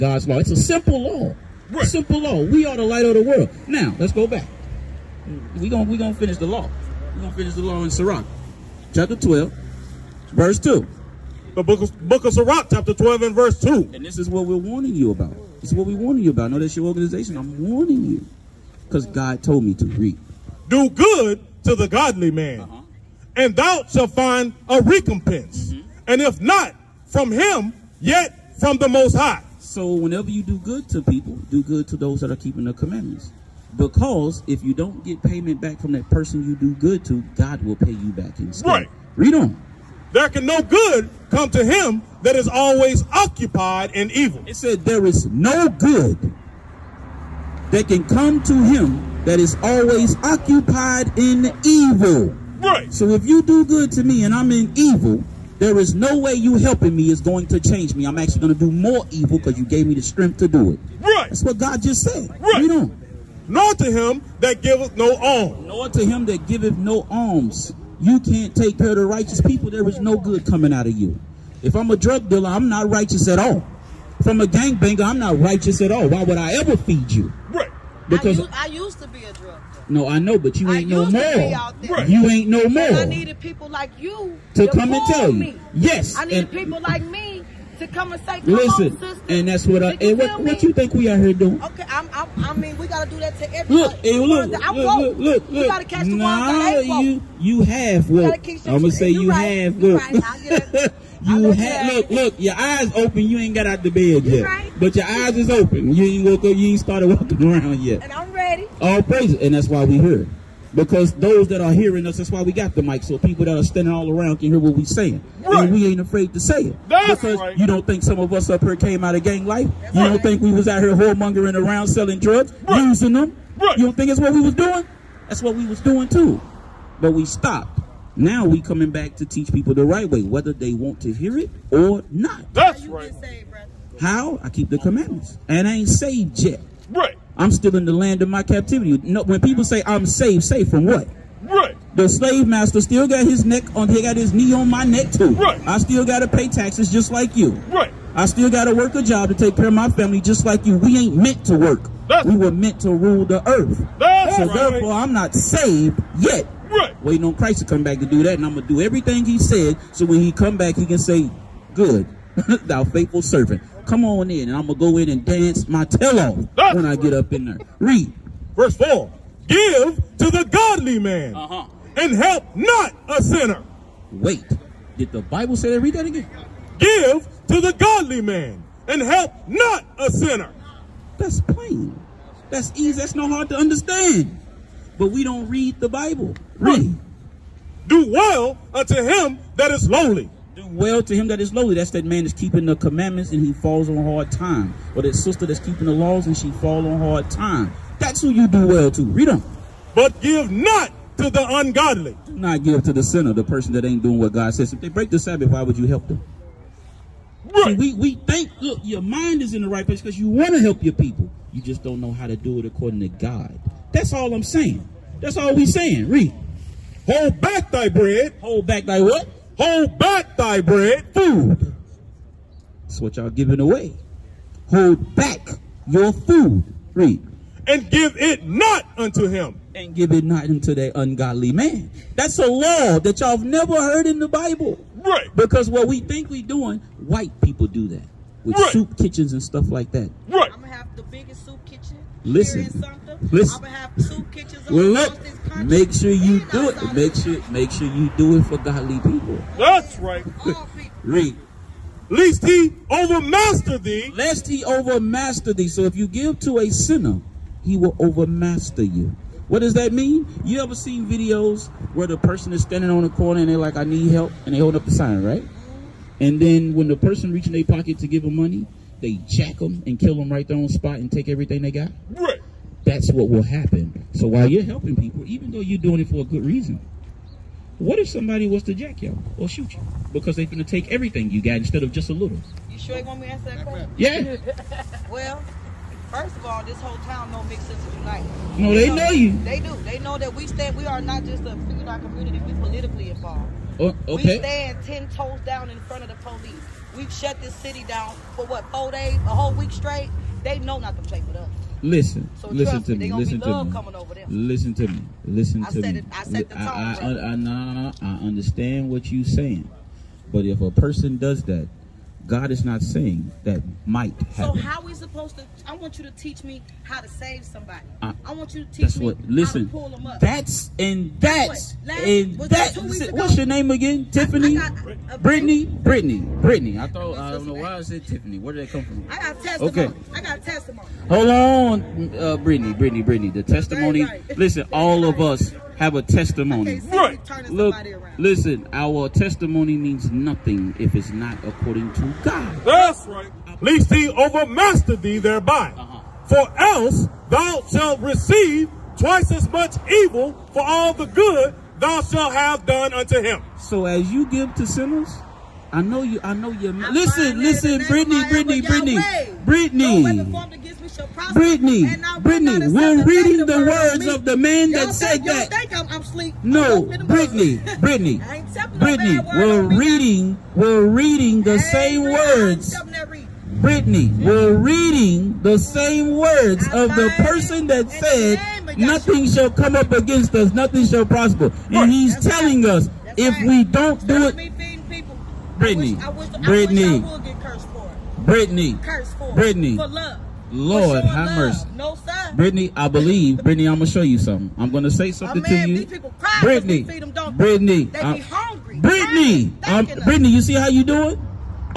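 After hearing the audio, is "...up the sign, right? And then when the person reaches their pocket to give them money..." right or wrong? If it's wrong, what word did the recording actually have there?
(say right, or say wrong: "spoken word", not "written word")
right.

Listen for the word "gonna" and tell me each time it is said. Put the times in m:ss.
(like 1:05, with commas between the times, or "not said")
0:05, 1:38, 2:38.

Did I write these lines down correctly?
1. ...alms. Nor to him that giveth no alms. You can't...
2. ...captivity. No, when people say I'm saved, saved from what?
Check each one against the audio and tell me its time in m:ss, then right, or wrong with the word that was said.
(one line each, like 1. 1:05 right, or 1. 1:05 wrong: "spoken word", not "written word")
1. 1:05 right
2. 2:18 right.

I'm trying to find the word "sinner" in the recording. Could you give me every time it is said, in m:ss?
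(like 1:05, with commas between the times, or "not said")
2:53, 3:00, 3:23, 4:16, 5:54.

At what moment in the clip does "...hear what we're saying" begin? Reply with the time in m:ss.
1:54.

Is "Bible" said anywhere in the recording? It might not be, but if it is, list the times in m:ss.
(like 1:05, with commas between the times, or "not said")
2:55, 3:05, 3:54.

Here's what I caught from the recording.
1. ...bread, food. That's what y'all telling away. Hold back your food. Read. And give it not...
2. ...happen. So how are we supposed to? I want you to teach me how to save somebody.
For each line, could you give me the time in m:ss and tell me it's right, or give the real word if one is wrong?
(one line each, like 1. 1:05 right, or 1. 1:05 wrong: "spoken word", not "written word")
1. 3:40 wrong: "giving", not "telling"
2. 5:14 right.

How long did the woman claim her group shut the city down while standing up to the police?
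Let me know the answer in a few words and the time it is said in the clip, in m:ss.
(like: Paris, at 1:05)
a whole week, at 4:59.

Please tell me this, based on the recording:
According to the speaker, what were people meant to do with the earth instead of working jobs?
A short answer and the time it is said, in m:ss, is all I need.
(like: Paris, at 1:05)
rule the earth, at 2:32.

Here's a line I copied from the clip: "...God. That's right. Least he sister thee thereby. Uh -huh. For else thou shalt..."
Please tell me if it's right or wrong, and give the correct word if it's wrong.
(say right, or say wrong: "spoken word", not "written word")
wrong: "overmaster", not "sister".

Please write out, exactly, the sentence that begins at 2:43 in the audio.
Come on in, and I'm going to go in and dance my tail off when I get up in there.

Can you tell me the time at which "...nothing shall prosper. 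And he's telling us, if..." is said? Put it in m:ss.
6:20.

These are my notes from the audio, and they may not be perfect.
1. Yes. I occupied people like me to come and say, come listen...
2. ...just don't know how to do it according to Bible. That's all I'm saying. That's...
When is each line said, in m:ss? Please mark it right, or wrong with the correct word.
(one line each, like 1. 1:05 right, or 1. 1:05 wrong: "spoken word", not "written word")
1. 1:25 wrong: "needed", not "occupied"
2. 3:31 wrong: "God", not "Bible".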